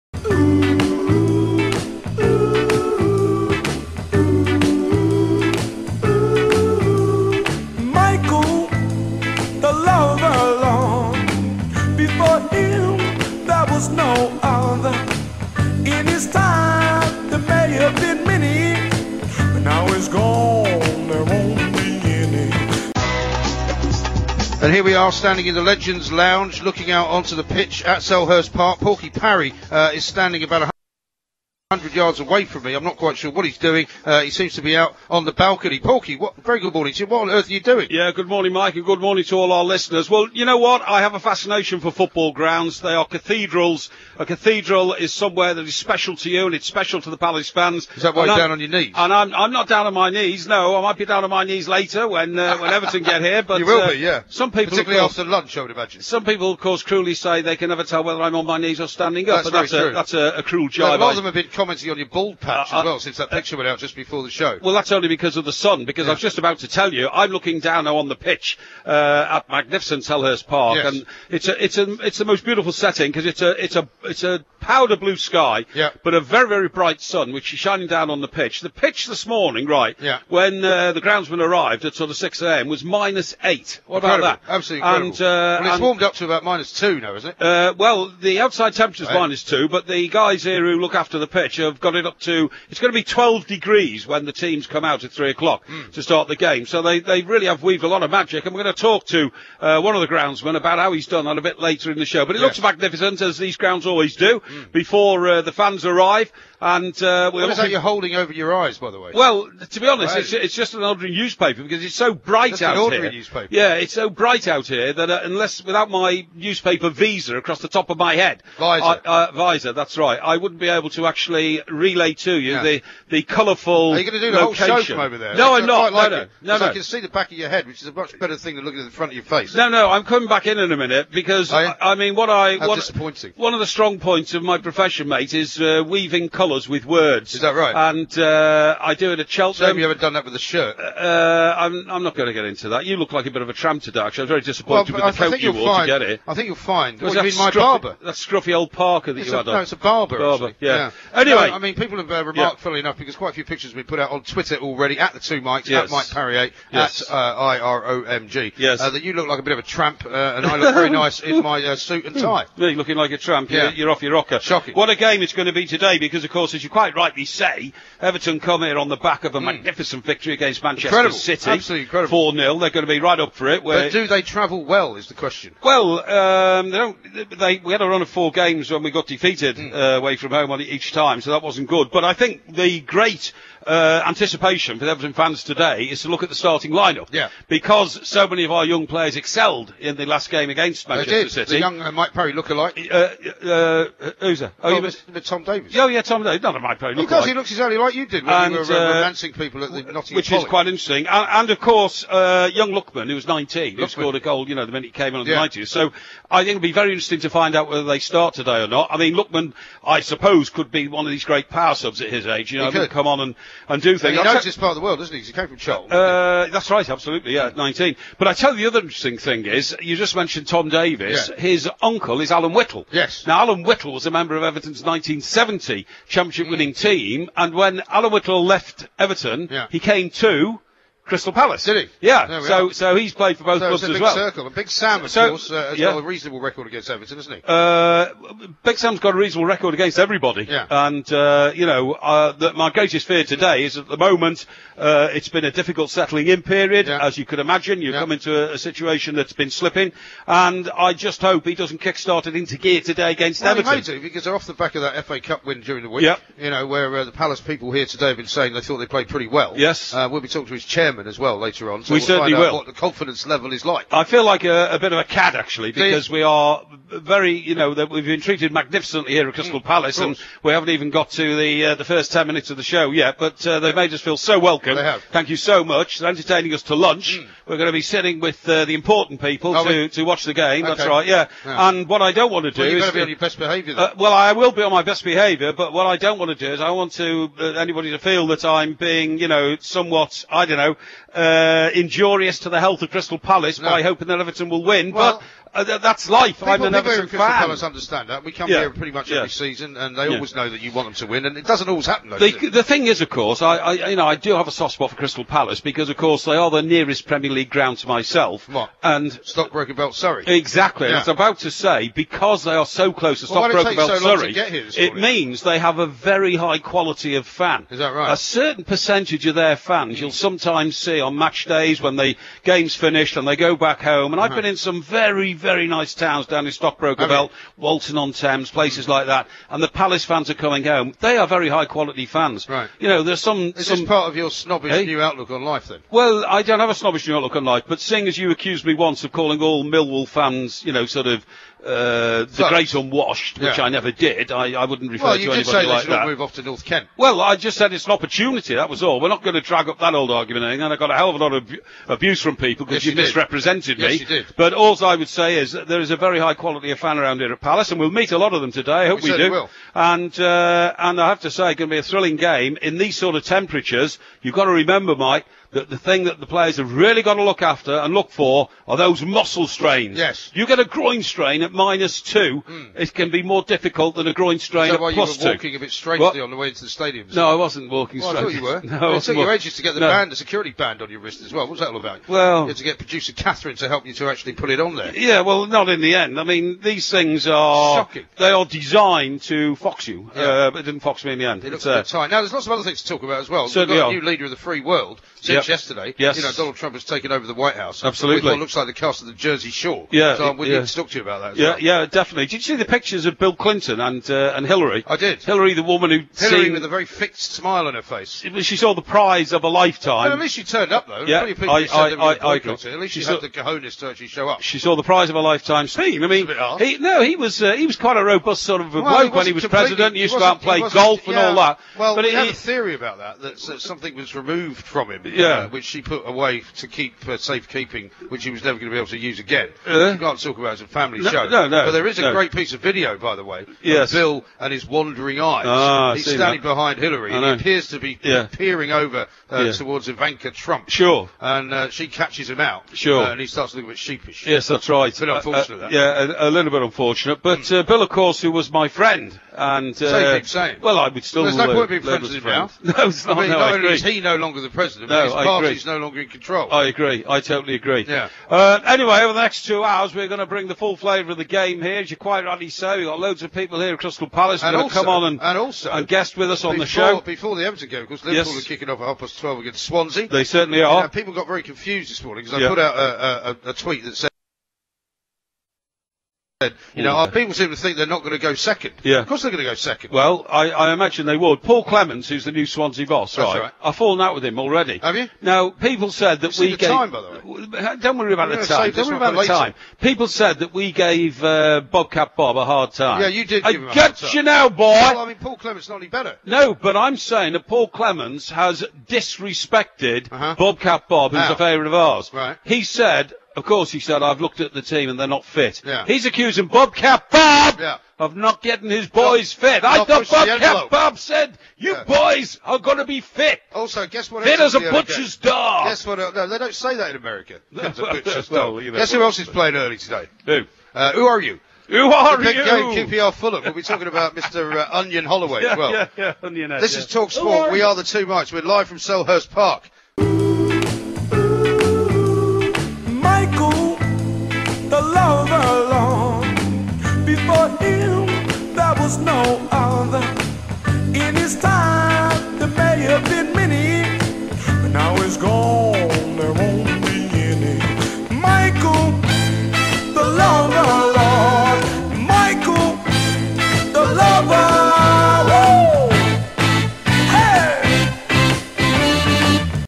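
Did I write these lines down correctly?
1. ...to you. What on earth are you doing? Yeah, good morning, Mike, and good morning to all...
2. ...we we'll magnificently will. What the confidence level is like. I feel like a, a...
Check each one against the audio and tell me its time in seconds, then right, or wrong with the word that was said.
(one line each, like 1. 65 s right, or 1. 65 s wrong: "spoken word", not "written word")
1. 36 s right
2. 261 s wrong: "certainly", not "magnificently".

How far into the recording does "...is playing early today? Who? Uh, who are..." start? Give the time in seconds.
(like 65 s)
519 s.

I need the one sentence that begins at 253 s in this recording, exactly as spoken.
He may do because they're off the back of that FA Cup win during the week.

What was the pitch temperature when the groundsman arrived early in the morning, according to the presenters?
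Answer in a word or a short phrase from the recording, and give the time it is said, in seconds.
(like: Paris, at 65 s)
minus 8, at 82 s.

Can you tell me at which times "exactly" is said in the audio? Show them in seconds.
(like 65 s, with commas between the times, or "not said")
197 s, 310 s.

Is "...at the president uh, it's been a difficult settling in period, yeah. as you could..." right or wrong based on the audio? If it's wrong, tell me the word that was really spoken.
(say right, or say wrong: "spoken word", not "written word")
wrong: "moment", not "president".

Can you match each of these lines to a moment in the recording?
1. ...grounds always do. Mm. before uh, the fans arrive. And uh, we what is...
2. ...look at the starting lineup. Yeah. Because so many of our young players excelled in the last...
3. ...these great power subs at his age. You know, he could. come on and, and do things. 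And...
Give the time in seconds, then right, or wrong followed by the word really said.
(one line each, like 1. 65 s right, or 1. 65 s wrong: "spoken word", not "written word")
1. 103 s right
2. 186 s right
3. 211 s right.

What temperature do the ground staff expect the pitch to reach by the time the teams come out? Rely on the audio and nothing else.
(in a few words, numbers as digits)
12 degrees.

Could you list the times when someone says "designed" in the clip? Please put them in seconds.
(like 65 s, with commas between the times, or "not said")
388 s.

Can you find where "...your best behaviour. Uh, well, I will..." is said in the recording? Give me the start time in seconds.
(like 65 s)
283 s.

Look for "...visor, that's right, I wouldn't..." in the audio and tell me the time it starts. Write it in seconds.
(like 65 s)
119 s.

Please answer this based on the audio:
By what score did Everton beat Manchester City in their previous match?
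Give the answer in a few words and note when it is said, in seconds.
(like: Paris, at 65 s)
4-0, at 172 s.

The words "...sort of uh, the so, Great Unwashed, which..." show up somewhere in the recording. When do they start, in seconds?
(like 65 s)
340 s.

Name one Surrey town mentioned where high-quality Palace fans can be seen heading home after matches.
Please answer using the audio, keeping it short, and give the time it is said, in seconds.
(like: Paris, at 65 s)
Walton on Thames, at 327 s.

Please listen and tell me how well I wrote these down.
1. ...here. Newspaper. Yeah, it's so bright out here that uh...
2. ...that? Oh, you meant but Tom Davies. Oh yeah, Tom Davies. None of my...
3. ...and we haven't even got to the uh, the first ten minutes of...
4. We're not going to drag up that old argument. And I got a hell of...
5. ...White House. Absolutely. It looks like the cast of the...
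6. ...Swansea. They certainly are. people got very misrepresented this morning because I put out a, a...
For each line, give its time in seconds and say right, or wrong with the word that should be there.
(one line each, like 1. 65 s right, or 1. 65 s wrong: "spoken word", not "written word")
1. 113 s right
2. 194 s right
3. 269 s right
4. 348 s right
5. 397 s right
6. 469 s wrong: "confused", not "misrepresented".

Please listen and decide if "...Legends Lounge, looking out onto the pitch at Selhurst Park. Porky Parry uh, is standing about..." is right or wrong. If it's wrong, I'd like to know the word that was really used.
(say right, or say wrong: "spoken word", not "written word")
right.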